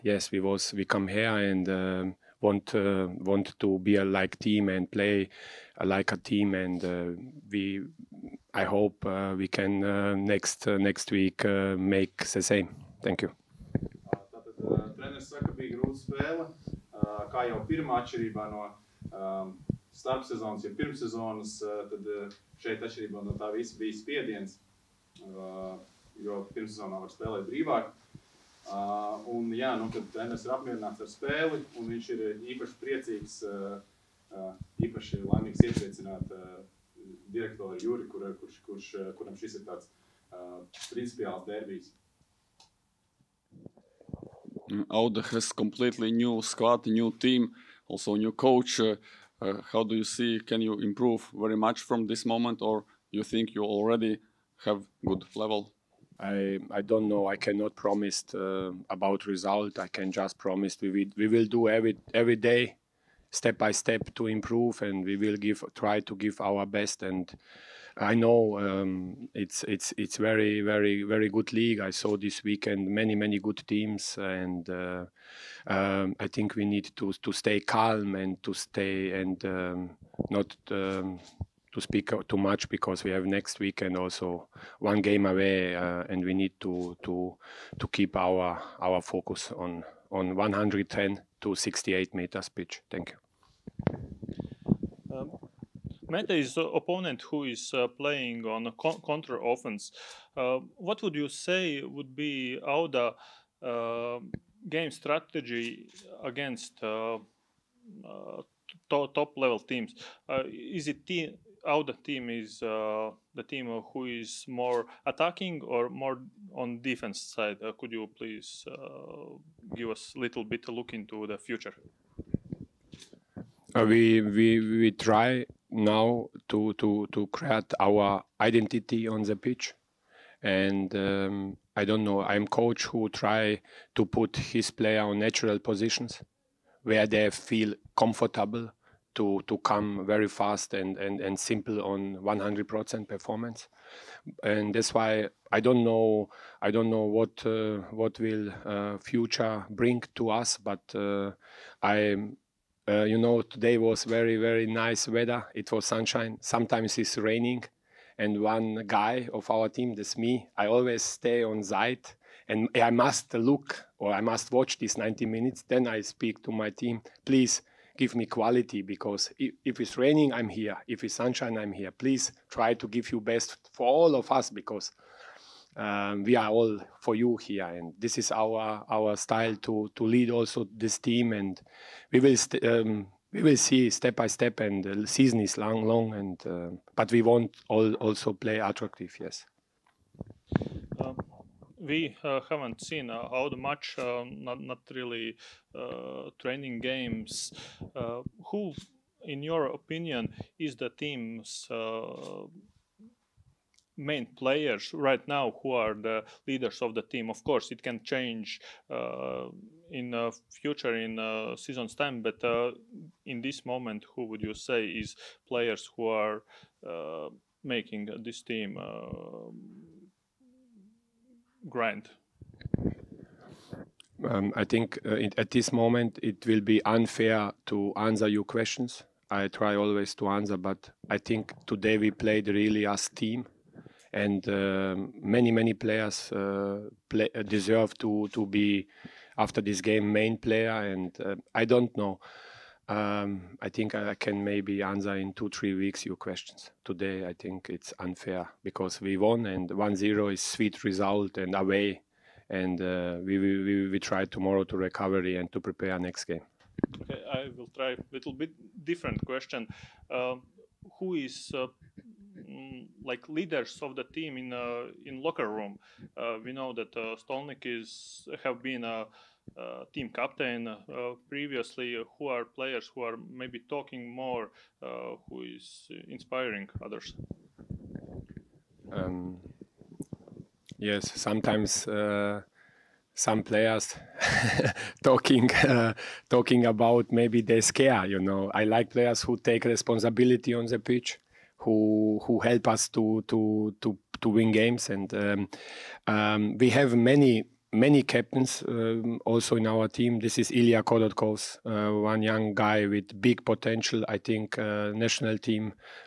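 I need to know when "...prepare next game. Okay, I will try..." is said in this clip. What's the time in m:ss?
4:15.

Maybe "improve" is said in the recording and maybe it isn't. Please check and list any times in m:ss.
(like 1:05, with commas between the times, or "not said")
0:50, 1:04.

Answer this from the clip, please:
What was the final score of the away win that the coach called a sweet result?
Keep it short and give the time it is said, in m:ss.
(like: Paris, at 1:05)
1-0, at 4:09.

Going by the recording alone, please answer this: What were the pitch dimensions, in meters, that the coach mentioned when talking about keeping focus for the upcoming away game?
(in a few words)
110 to 68 meters.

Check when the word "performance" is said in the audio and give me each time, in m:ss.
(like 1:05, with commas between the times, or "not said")
2:23.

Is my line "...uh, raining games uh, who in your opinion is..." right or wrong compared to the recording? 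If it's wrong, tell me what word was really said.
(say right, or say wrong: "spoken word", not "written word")
wrong: "training", not "raining".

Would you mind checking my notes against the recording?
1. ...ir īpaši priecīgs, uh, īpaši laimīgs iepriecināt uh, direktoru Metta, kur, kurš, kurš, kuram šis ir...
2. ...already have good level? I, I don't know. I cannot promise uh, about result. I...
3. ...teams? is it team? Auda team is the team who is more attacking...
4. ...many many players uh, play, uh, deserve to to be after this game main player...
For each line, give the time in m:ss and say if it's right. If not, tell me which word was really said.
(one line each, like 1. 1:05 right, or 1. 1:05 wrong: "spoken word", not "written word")
1. 0:32 wrong: "Juri", not "Metta"
2. 0:53 right
3. 1:49 right
4. 3:55 right.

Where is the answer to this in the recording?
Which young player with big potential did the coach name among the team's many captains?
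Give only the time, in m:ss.
5:00.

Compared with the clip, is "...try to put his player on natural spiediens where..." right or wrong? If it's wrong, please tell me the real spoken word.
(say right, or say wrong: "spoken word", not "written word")
wrong: "positions", not "spiediens".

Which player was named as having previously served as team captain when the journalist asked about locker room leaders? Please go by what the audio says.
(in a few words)
Stolnik.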